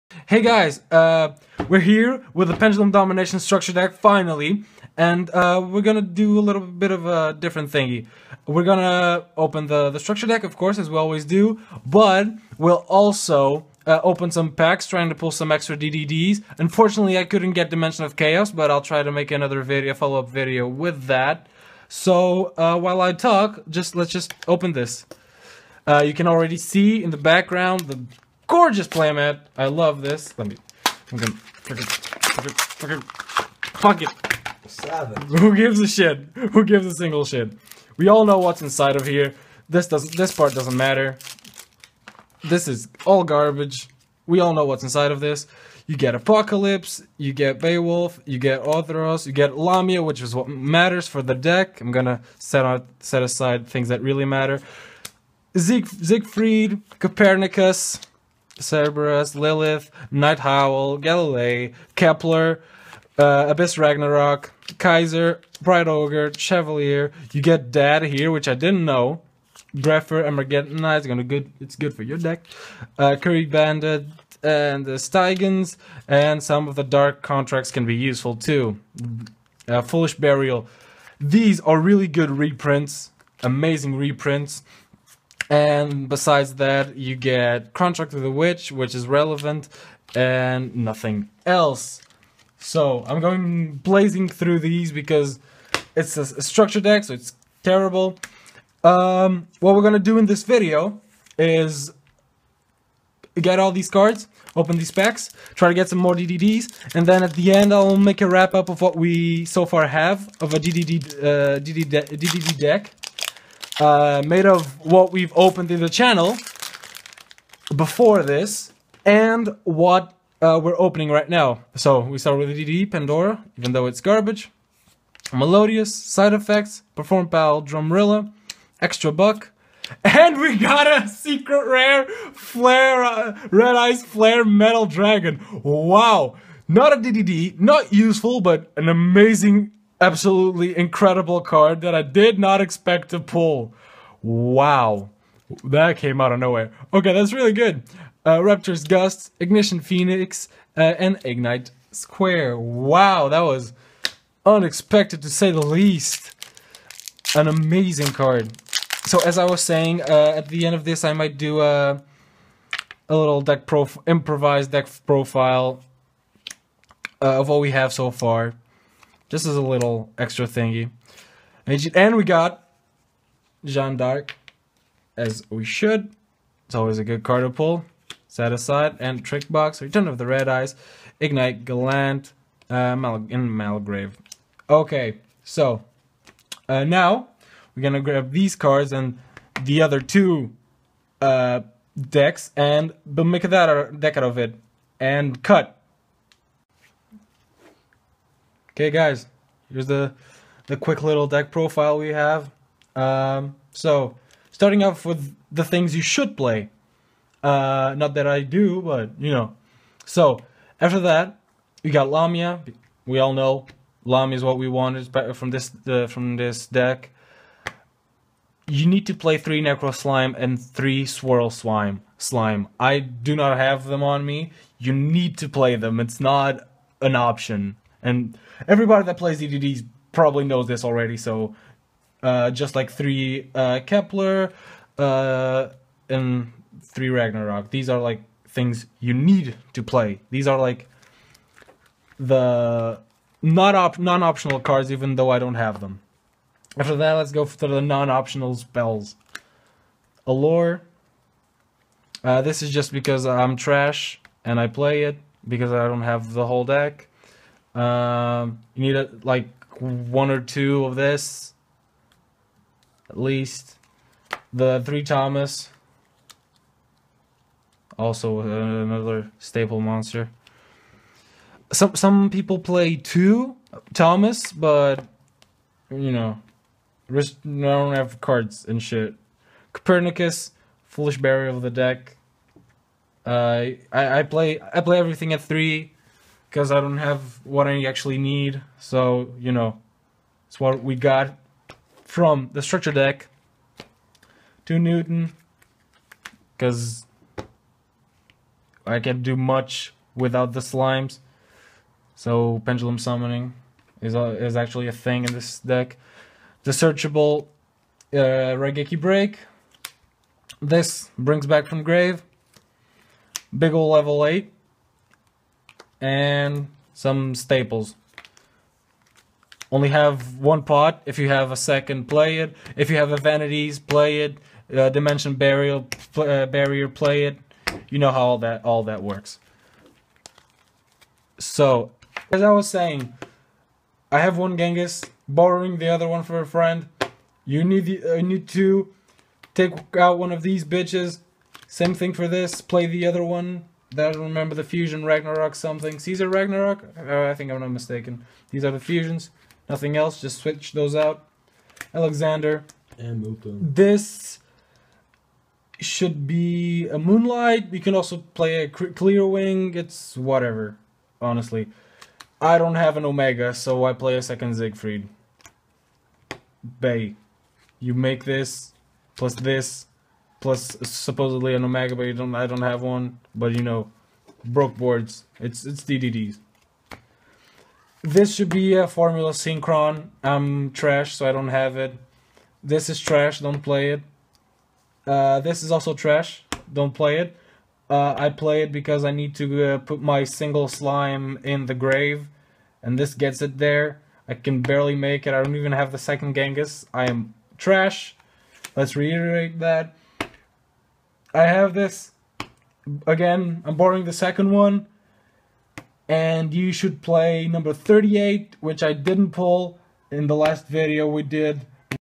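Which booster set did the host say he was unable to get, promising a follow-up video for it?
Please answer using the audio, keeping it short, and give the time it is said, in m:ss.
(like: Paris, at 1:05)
Dimension of Chaos, at 0:17.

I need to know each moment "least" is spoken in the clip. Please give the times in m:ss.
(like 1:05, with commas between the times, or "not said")
2:35, 4:23.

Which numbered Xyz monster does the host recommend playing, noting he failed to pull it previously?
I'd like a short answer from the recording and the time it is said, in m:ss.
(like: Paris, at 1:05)
Number 38, at 6:47.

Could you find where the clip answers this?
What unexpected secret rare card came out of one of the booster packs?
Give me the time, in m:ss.
2:13.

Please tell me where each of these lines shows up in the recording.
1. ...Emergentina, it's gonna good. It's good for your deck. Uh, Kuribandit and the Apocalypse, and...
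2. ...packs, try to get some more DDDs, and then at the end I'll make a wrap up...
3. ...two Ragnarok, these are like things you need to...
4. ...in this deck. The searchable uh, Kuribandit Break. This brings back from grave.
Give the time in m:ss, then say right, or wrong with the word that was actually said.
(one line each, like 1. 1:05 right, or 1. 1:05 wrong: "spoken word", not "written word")
1. 1:10 wrong: "Steigens", not "Apocalypse"
2. 1:44 right
3. 3:56 wrong: "three", not "two"
4. 5:05 wrong: "Raigeki", not "Kuribandit".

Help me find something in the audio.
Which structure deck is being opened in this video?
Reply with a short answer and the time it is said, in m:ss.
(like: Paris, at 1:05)
Pendulum Domination, at 0:02.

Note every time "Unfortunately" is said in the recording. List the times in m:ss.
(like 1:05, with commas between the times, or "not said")
0:16.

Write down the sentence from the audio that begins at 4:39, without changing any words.
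Copernicus, Foolish Burial of the deck.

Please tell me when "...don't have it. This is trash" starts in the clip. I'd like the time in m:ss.
6:21.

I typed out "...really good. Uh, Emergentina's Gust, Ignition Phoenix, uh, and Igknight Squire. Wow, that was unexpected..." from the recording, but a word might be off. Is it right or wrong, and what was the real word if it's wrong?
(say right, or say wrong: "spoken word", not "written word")
wrong: "Raptor", not "Emergentina".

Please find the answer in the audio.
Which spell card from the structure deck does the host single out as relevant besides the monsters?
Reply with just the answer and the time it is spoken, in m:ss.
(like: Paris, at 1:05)
Contract with the Witch, at 1:27.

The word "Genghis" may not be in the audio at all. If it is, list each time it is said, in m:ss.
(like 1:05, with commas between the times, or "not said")
5:34, 6:36.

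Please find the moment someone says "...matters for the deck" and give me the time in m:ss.
0:50.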